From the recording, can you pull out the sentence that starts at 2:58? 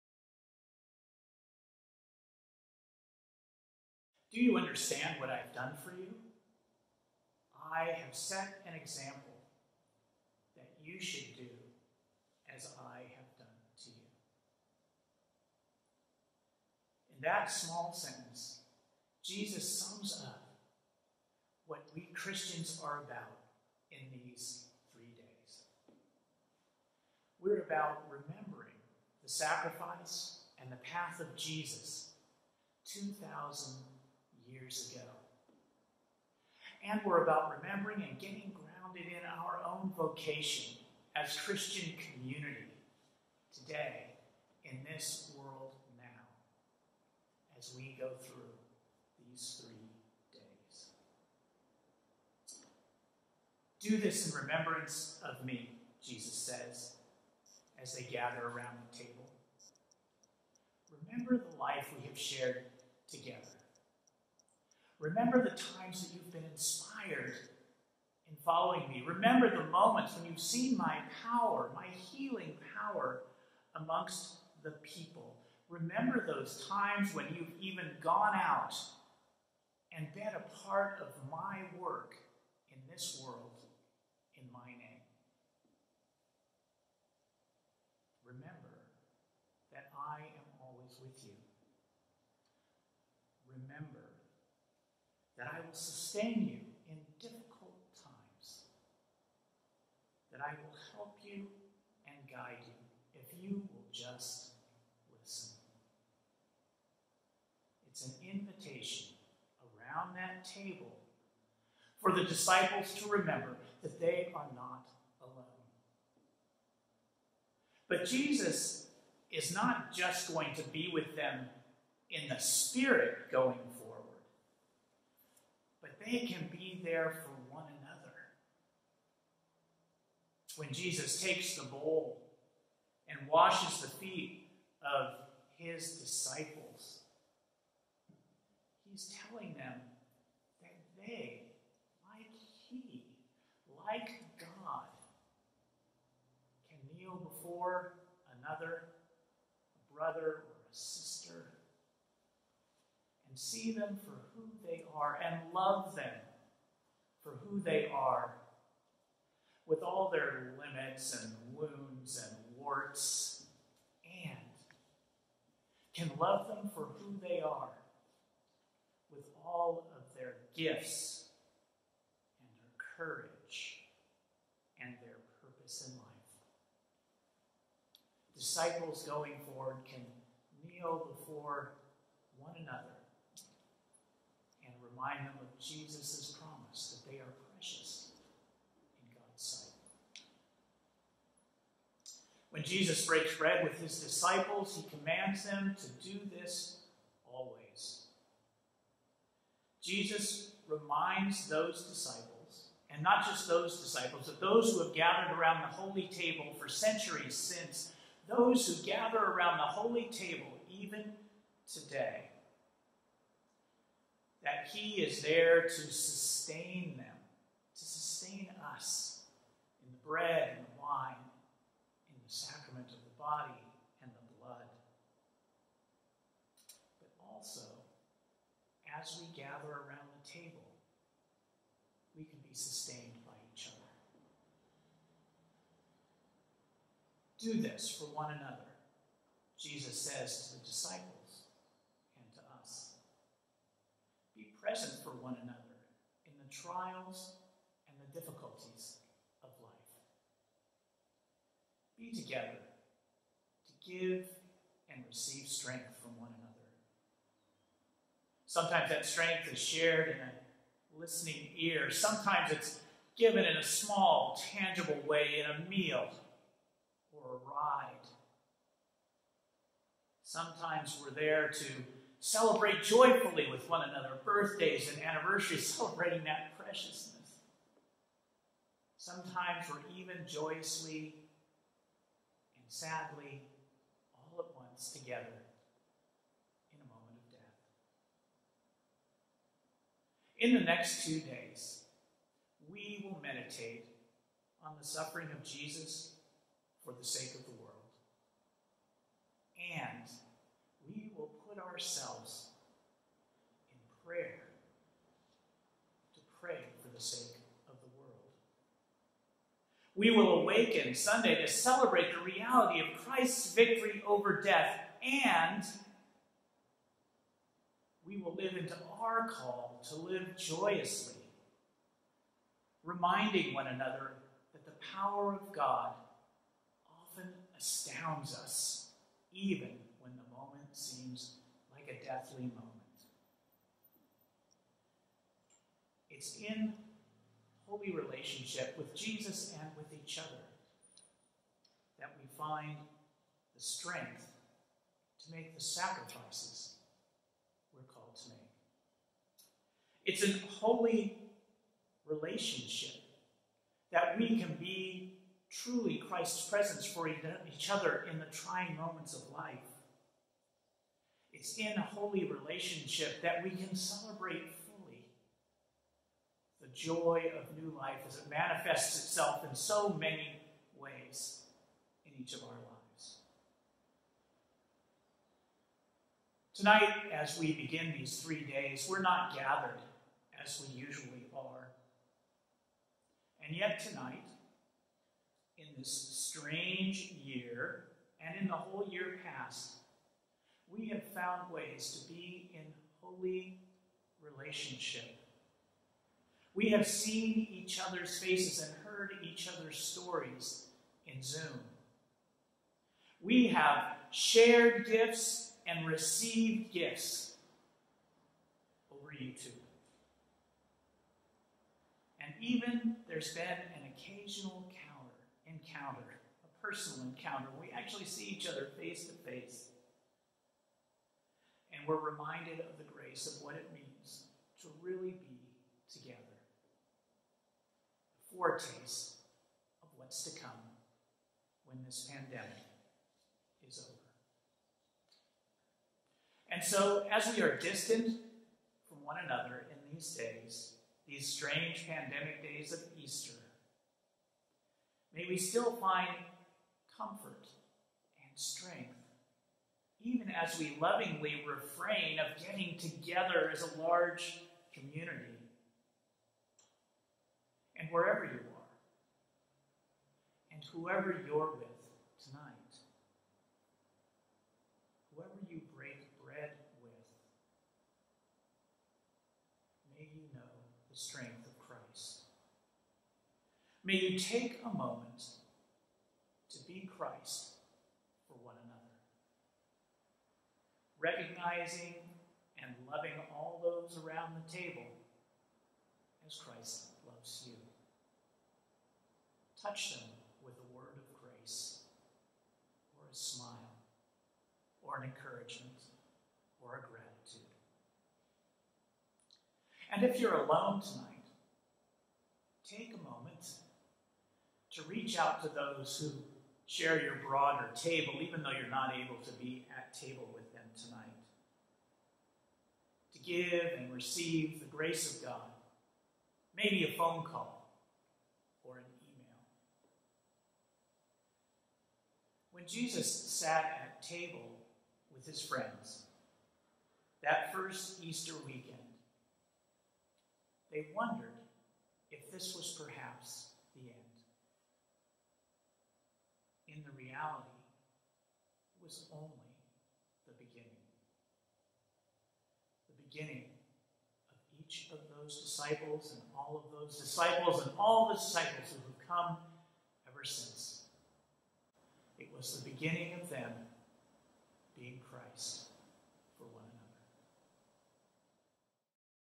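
Disciples going forward can kneel before one another remind them of Jesus' promise that they are precious in God's sight.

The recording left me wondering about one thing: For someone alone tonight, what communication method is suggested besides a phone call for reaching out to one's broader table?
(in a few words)
email.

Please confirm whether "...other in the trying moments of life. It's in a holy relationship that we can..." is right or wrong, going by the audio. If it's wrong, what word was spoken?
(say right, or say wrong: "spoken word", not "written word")
right.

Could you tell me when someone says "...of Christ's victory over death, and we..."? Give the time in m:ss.
5:12.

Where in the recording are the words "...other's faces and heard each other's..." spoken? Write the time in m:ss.
6:37.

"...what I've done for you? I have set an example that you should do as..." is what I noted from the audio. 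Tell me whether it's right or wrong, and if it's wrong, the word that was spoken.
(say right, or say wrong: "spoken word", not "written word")
right.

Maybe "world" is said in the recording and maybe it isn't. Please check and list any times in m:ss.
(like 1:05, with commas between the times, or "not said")
0:45, 1:23, 4:57, 5:07.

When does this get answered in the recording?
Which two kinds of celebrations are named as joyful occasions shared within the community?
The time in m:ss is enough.
4:34.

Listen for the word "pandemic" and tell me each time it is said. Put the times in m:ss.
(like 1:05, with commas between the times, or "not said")
7:12, 7:21.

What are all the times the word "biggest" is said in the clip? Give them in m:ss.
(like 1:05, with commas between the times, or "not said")
not said.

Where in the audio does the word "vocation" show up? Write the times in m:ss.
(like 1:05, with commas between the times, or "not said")
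0:39.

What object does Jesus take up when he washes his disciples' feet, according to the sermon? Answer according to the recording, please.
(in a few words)
bowl.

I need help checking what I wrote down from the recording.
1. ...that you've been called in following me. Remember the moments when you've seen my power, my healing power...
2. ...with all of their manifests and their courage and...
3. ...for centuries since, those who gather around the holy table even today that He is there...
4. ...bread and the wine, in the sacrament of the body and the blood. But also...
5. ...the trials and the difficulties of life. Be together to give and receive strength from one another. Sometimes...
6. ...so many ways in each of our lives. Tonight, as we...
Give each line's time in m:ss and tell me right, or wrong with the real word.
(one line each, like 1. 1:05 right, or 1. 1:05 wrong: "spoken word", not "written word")
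1. 1:06 wrong: "inspired", not "called"
2. 2:49 wrong: "gifts", not "manifests"
3. 3:26 right
4. 3:40 right
5. 4:06 right
6. 6:09 right.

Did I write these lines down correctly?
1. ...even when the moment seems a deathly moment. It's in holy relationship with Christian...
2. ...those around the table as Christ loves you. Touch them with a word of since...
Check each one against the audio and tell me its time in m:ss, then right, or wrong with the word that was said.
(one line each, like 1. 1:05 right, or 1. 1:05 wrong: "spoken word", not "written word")
1. 5:29 wrong: "Jesus", not "Christian"
2. 8:03 wrong: "grace", not "since".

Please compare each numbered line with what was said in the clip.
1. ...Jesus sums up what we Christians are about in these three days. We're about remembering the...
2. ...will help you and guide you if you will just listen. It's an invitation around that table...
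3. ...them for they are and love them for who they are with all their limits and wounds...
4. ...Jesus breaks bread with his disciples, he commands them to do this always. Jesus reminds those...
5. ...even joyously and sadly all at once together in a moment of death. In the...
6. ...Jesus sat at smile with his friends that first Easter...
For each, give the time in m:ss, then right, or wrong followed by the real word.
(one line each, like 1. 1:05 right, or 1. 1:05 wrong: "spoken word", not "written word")
1. 0:19 right
2. 1:40 right
3. 2:33 right
4. 3:12 right
5. 4:39 right
6. 8:42 wrong: "table", not "smile".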